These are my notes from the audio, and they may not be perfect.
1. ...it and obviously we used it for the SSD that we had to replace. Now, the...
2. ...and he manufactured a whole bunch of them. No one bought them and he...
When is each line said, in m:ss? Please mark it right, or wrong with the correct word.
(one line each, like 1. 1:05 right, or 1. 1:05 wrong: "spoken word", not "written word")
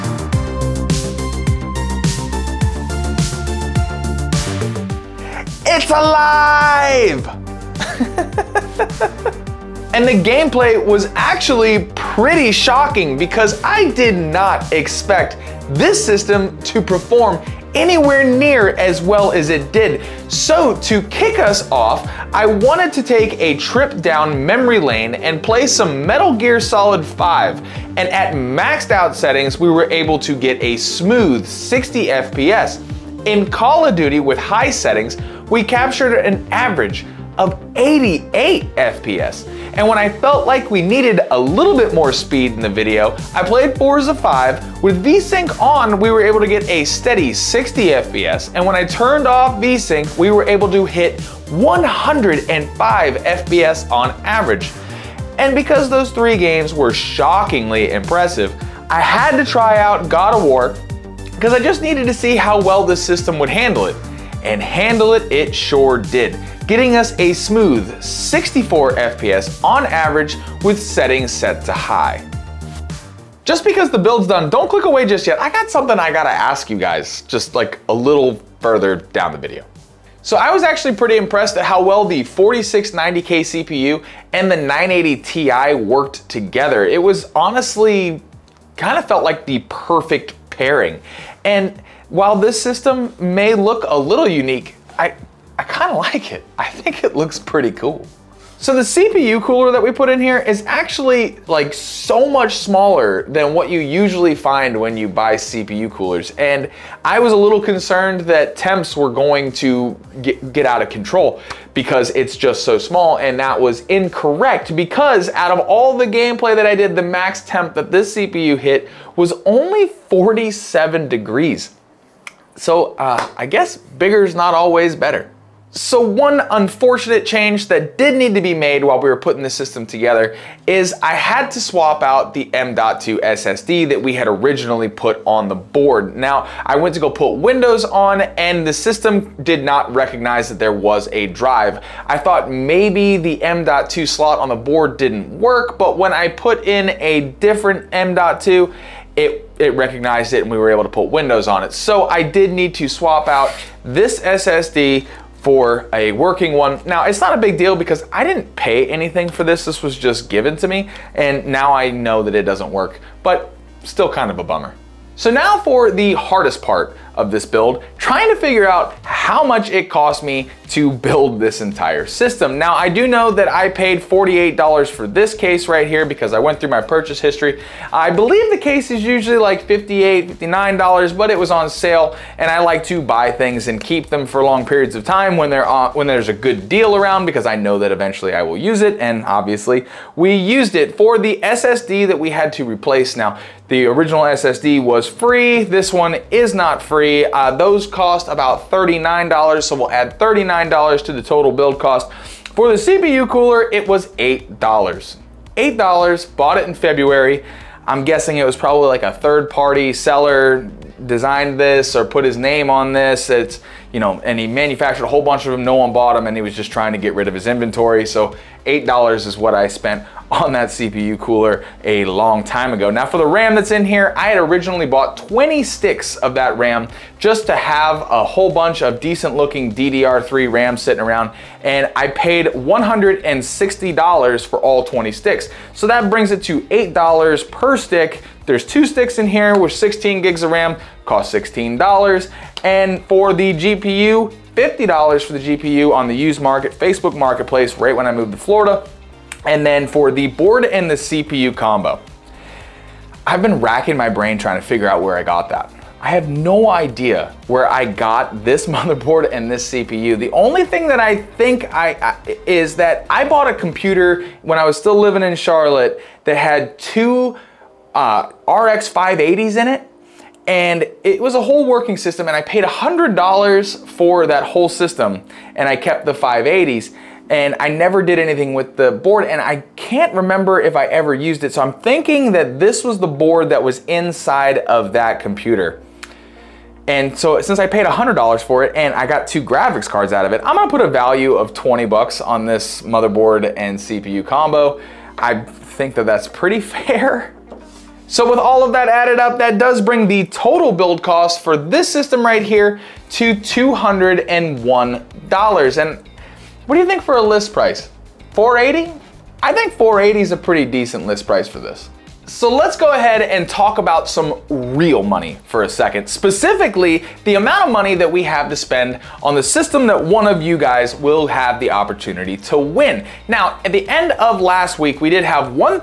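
1. 3:08 right
2. 3:34 right.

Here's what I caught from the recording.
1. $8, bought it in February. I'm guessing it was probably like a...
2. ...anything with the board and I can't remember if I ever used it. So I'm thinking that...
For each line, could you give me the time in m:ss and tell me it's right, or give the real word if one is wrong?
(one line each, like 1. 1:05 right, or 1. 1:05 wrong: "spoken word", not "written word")
1. 3:24 right
2. 4:38 right.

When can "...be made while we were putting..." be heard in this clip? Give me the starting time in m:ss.
2:08.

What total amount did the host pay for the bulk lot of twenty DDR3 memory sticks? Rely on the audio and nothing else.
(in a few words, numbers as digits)
$160.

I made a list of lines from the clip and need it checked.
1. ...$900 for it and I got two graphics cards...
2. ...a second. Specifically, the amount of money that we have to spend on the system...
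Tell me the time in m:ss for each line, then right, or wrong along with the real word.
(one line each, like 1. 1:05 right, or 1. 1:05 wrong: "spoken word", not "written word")
1. 4:47 wrong: "100", not "900"
2. 5:15 right.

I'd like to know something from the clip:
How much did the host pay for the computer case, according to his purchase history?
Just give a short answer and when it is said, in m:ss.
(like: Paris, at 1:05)
$48, at 2:54.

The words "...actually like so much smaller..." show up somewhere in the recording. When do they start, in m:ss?
1:40.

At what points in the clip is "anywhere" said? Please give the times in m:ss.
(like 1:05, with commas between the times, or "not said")
0:17.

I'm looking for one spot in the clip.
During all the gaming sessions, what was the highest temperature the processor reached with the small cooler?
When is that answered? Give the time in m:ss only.
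2:00.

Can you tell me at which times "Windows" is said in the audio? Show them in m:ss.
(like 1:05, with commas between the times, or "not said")
2:17, 2:31.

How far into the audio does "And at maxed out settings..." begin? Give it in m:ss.
0:27.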